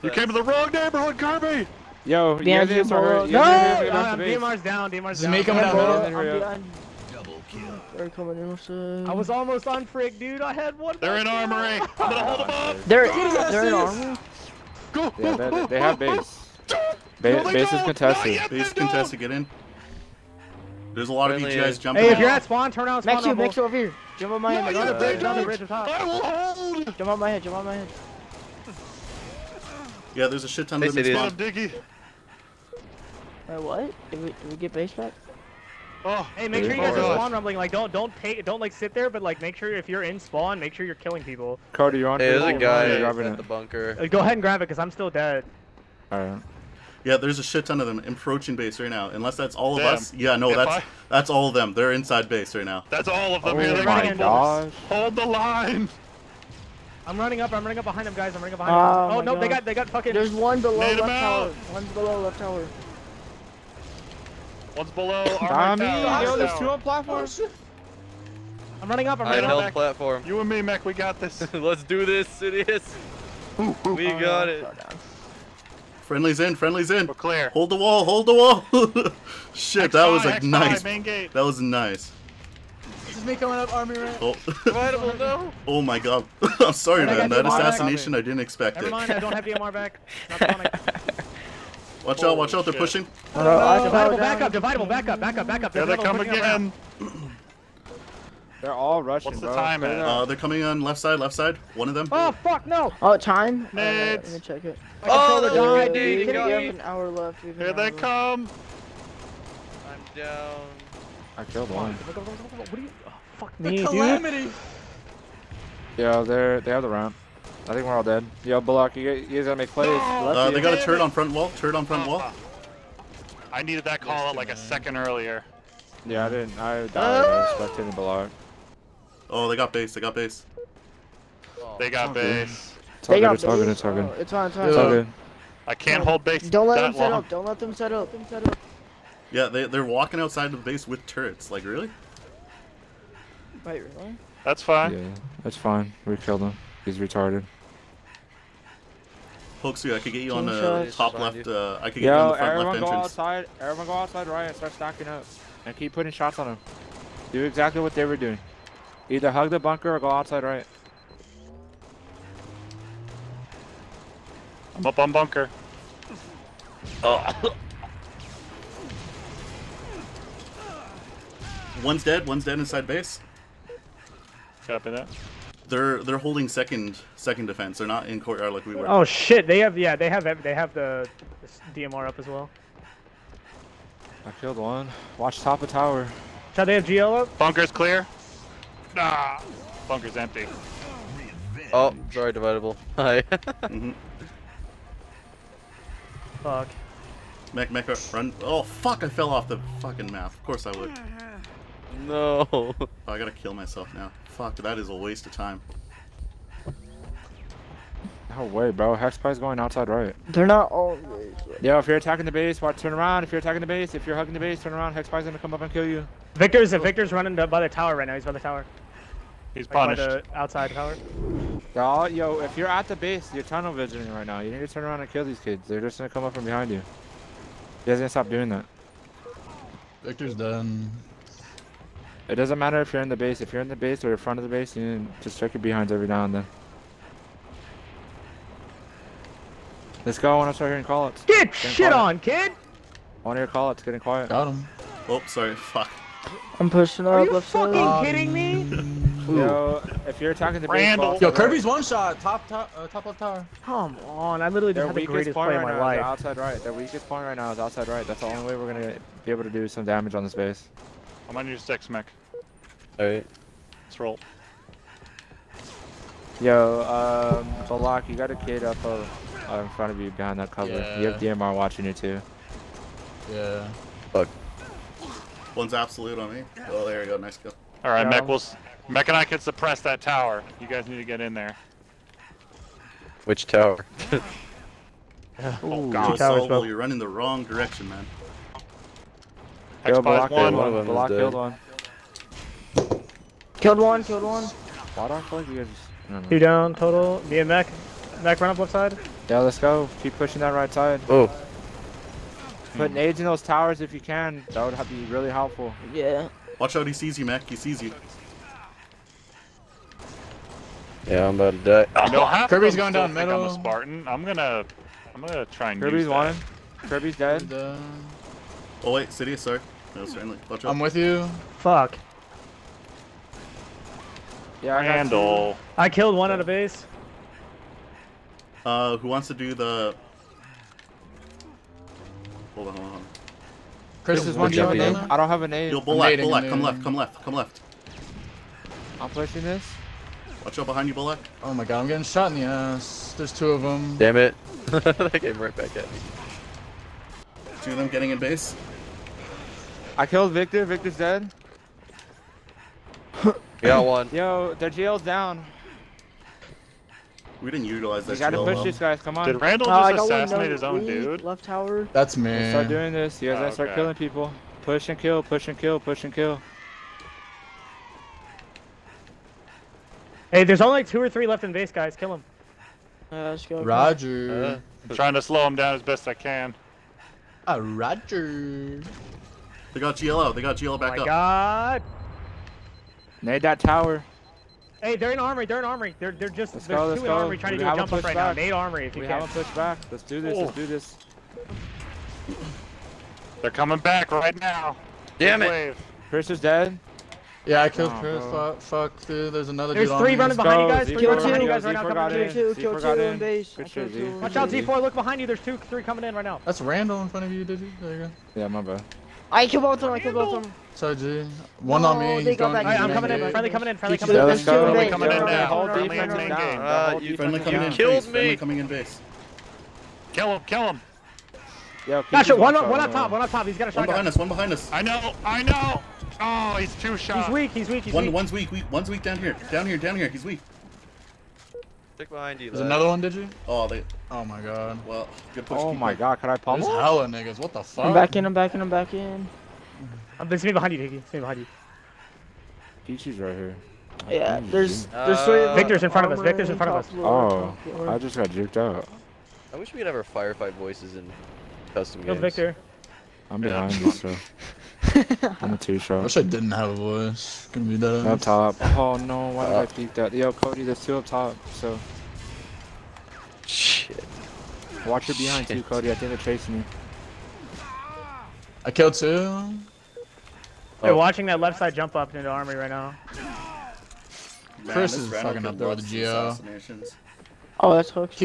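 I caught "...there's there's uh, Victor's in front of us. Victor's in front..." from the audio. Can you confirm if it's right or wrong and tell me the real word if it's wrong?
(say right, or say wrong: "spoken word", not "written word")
right.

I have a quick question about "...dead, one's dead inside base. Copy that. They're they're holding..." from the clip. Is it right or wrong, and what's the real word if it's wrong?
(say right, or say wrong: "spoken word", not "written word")
right.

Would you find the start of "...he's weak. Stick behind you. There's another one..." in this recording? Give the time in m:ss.
7:10.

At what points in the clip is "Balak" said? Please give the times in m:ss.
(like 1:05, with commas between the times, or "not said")
1:58, 2:07, 4:27.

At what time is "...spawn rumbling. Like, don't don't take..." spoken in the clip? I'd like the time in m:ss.
0:37.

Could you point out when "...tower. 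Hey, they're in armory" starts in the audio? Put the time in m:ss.
6:23.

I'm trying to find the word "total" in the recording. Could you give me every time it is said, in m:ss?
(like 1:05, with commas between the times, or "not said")
4:56.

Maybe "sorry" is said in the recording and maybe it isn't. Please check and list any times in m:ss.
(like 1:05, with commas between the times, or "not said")
1:26, 3:12, 4:05, 5:19.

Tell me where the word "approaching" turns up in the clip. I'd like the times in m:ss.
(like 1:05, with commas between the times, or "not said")
0:48.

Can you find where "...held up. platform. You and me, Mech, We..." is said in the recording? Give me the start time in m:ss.
1:09.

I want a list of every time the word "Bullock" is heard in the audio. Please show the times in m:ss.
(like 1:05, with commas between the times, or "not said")
5:35, 5:40.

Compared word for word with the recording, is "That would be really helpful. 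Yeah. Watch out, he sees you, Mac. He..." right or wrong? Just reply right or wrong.
right.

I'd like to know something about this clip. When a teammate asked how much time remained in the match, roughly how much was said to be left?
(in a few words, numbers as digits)
an hour.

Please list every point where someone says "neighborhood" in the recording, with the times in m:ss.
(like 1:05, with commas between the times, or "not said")
0:00.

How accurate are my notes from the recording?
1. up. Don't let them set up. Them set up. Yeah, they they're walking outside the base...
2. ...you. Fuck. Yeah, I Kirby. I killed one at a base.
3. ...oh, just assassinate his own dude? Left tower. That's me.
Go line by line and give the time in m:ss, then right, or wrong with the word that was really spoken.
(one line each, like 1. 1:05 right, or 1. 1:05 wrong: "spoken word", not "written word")
1. 2:17 right
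2. 5:20 wrong: "Handle", not "Kirby"
3. 5:59 right.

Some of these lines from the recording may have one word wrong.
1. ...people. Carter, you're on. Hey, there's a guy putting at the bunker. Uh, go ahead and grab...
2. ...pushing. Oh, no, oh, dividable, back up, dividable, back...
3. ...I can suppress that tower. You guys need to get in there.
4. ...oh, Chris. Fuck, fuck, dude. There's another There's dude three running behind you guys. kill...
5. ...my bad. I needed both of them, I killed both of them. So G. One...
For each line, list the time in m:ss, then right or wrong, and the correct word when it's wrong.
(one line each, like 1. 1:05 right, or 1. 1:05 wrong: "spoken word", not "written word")
1. 0:41 wrong: "grabbing", not "putting"
2. 1:32 right
3. 4:39 right
4. 6:37 right
5. 6:48 wrong: "killed", not "needed".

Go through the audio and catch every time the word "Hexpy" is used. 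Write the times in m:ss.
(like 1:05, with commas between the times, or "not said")
3:28, 3:34.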